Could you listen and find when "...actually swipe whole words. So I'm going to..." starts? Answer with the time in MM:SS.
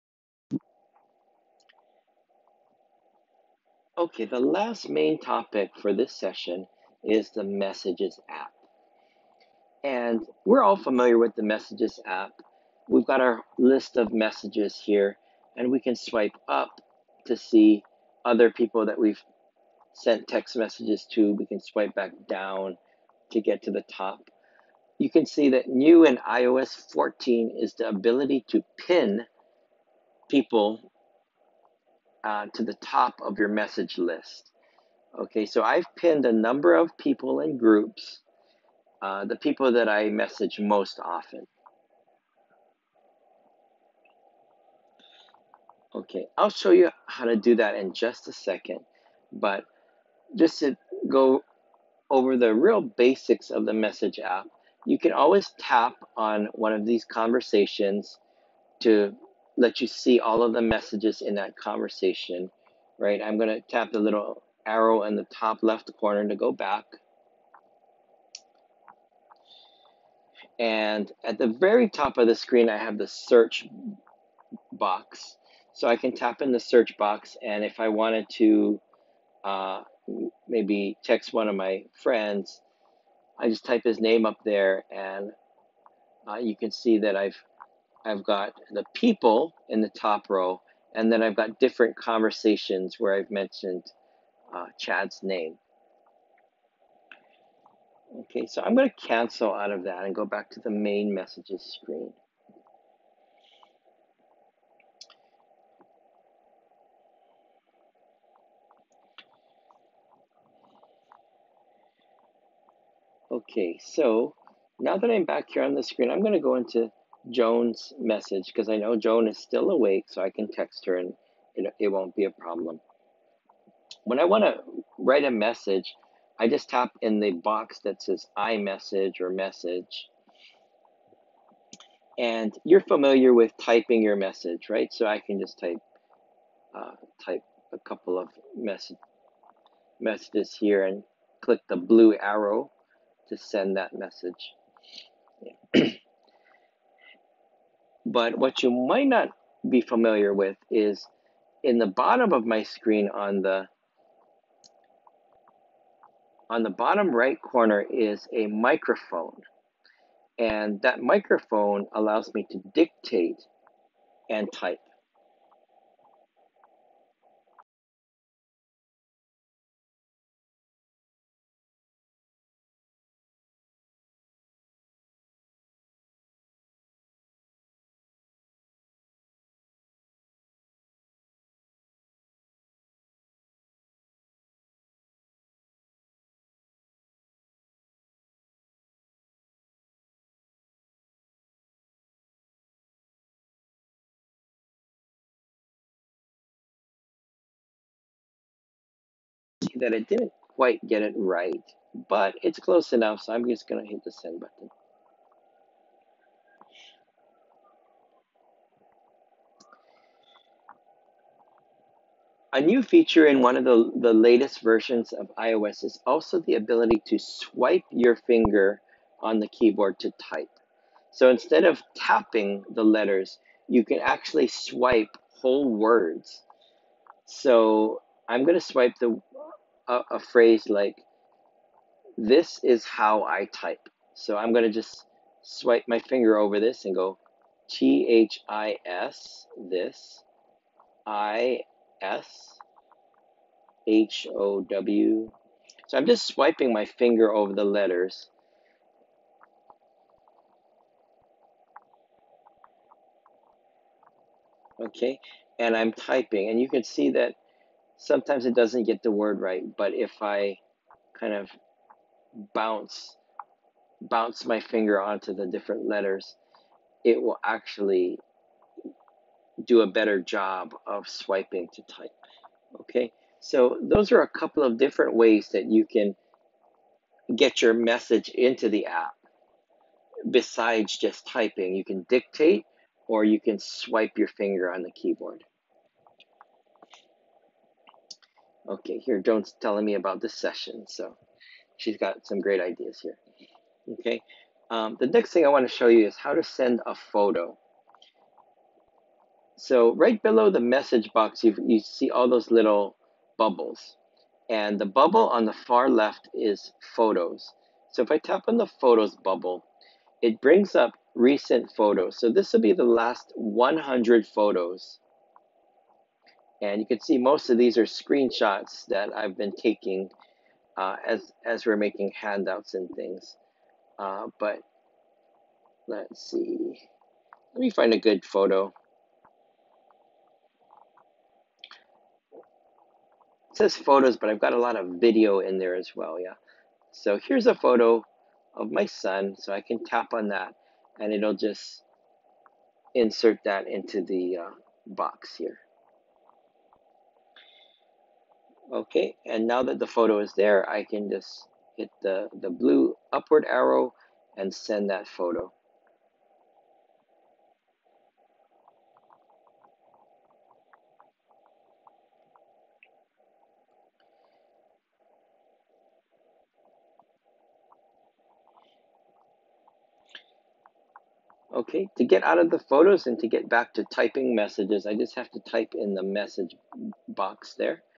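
03:43.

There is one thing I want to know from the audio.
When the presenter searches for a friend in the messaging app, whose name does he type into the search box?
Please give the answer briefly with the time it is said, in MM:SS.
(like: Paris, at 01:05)
Chad, at 01:34.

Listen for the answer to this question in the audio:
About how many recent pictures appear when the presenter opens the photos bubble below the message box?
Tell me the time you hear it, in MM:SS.
05:13.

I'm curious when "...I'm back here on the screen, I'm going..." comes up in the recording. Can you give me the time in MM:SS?
01:55.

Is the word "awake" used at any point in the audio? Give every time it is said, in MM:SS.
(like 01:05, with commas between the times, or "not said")
01:59.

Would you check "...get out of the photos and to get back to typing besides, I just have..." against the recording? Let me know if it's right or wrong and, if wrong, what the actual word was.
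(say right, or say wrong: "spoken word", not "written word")
wrong: "messages", not "besides".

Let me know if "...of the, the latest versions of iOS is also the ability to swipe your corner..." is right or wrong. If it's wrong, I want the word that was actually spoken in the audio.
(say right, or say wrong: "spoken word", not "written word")
wrong: "finger", not "corner".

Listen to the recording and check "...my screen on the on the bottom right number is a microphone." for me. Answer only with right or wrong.
wrong.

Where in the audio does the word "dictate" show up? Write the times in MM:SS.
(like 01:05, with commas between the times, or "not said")
02:42, 04:42.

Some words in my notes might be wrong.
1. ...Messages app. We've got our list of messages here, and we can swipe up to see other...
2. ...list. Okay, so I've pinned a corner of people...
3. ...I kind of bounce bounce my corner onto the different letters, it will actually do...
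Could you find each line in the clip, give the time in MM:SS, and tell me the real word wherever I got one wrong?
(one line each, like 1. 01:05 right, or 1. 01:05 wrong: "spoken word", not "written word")
1. 00:11 right
2. 00:33 wrong: "number", not "corner"
3. 04:20 wrong: "finger", not "corner".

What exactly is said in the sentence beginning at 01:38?
Okay, so I'm going to cancel out of that and go back to the main messages screen.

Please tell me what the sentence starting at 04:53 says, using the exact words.
Okay, um, the next thing I want to show you is how to send a photo.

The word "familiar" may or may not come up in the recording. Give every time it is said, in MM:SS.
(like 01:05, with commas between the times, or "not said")
00:10, 02:12, 02:29.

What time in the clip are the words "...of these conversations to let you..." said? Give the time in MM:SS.
00:56.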